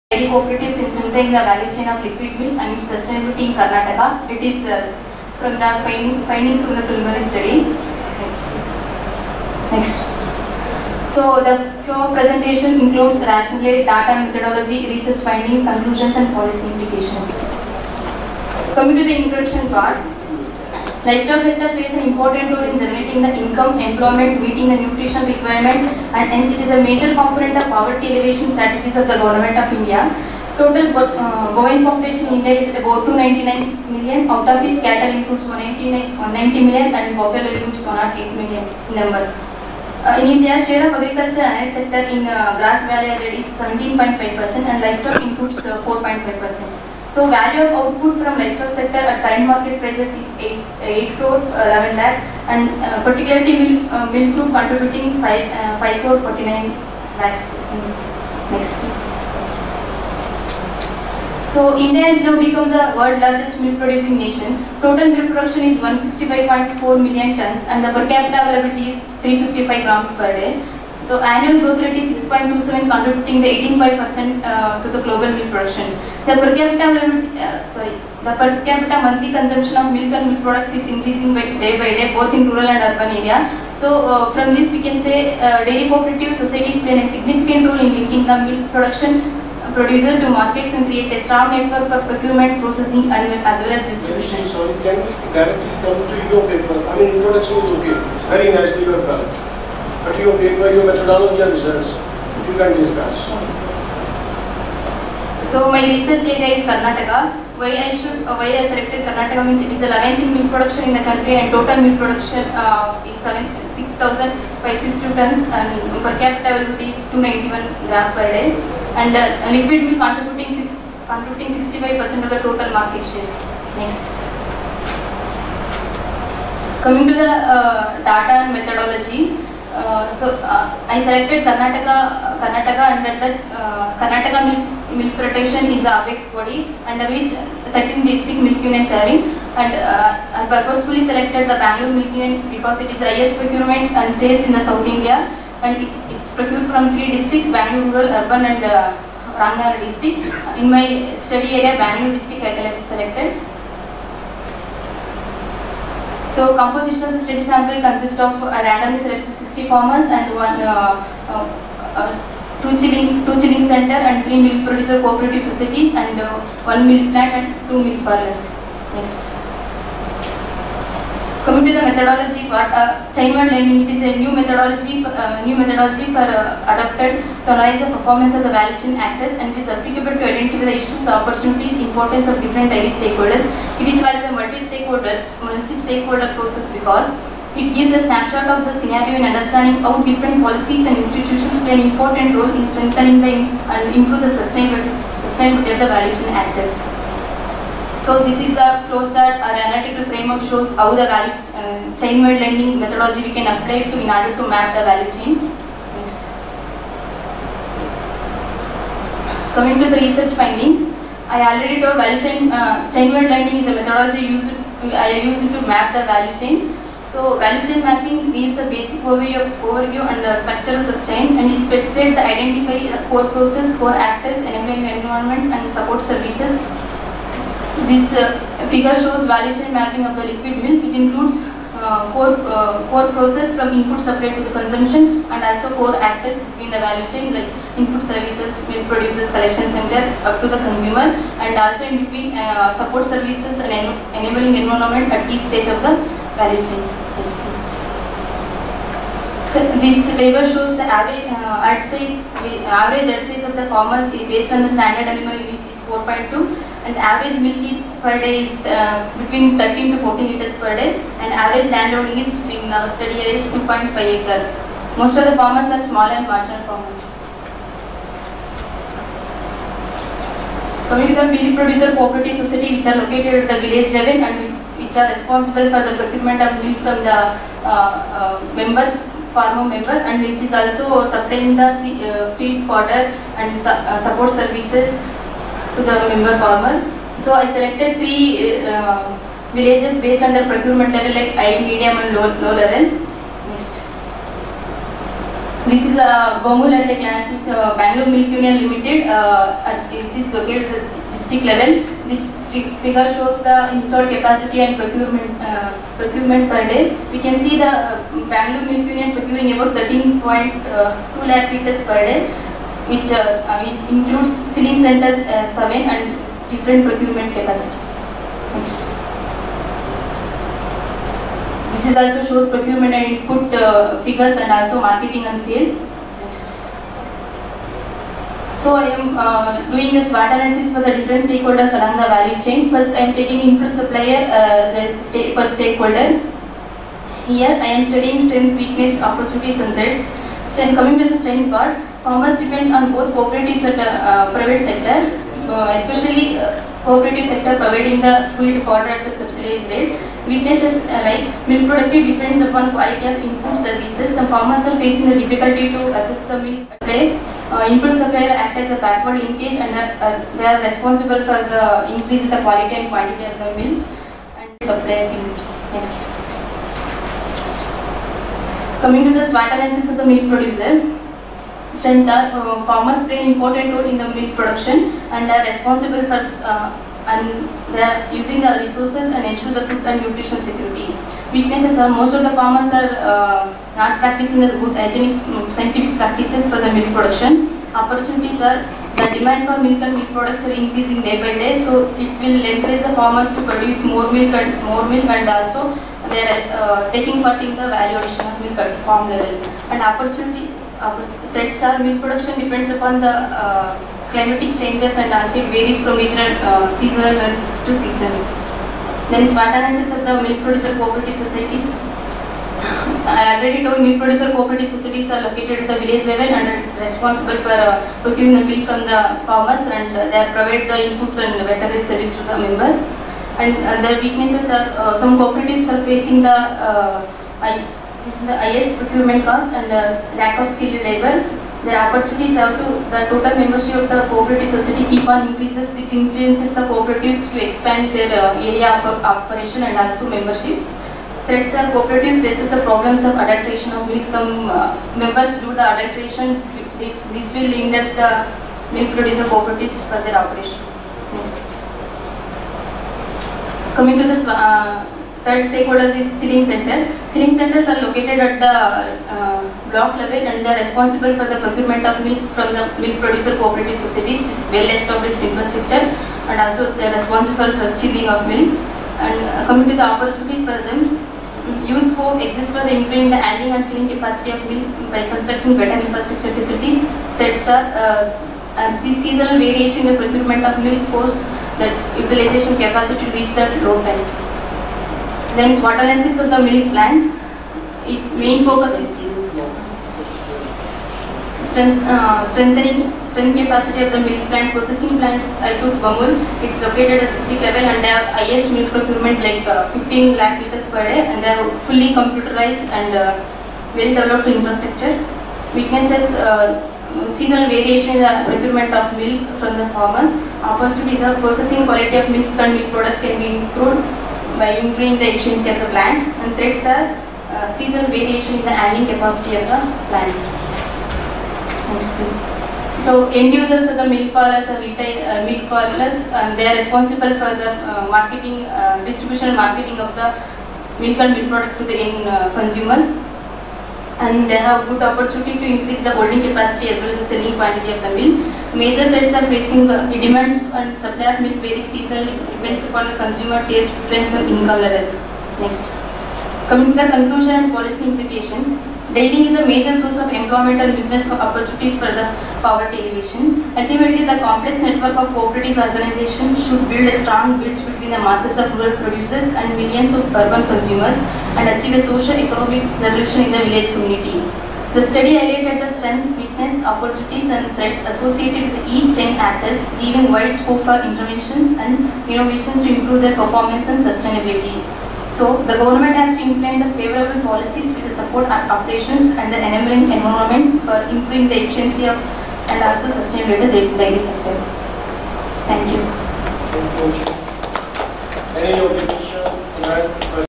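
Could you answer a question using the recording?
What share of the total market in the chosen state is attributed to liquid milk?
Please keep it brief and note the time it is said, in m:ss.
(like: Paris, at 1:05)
65%, at 2:01.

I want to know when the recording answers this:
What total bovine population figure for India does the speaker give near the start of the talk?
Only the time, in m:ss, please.
0:33.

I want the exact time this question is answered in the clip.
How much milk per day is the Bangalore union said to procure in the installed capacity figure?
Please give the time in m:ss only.
5:09.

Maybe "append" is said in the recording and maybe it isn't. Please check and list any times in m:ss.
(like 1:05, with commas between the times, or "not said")
not said.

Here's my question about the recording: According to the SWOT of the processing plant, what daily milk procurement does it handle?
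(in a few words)
15 lakh liters.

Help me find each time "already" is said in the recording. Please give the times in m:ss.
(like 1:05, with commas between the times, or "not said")
3:31, 6:53.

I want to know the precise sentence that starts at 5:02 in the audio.
This figure shows the installed capacity and procurement uh, procurement per day.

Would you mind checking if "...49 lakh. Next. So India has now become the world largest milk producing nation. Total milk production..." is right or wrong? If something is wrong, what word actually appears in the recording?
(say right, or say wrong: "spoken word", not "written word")
right.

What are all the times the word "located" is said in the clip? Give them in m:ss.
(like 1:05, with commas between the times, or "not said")
4:32, 5:00, 6:55, 7:37, 8:16.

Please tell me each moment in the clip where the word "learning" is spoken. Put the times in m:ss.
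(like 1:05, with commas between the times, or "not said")
2:53, 3:22, 3:33.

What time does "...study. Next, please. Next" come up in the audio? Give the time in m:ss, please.
0:07.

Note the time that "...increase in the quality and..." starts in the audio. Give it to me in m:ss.
6:01.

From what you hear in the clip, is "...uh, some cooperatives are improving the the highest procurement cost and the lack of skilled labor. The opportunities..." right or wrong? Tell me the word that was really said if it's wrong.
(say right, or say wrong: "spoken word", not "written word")
wrong: "facing", not "improving".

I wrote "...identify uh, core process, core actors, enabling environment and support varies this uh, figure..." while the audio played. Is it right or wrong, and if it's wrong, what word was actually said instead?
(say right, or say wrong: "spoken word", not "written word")
wrong: "services", not "varies".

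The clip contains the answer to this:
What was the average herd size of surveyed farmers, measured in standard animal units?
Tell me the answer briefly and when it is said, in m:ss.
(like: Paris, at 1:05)
4.2, at 4:15.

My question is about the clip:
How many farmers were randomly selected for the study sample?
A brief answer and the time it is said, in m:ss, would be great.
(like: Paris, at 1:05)
60, at 2:39.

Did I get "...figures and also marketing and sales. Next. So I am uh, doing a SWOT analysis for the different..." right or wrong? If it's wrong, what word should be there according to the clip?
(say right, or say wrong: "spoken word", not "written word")
right.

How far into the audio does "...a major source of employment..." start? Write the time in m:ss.
9:09.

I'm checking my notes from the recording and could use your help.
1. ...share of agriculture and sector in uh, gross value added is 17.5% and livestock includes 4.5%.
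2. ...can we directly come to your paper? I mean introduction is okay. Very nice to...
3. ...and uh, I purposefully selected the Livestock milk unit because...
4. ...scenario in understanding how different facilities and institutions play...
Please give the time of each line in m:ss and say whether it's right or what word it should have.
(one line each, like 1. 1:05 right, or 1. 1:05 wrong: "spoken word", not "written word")
1. 0:40 right
2. 1:34 right
3. 2:19 wrong: "Bangalore", not "Livestock"
4. 3:08 wrong: "policies", not "facilities".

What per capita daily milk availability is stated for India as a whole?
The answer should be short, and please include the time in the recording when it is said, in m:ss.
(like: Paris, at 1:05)
355 grams per day, at 1:09.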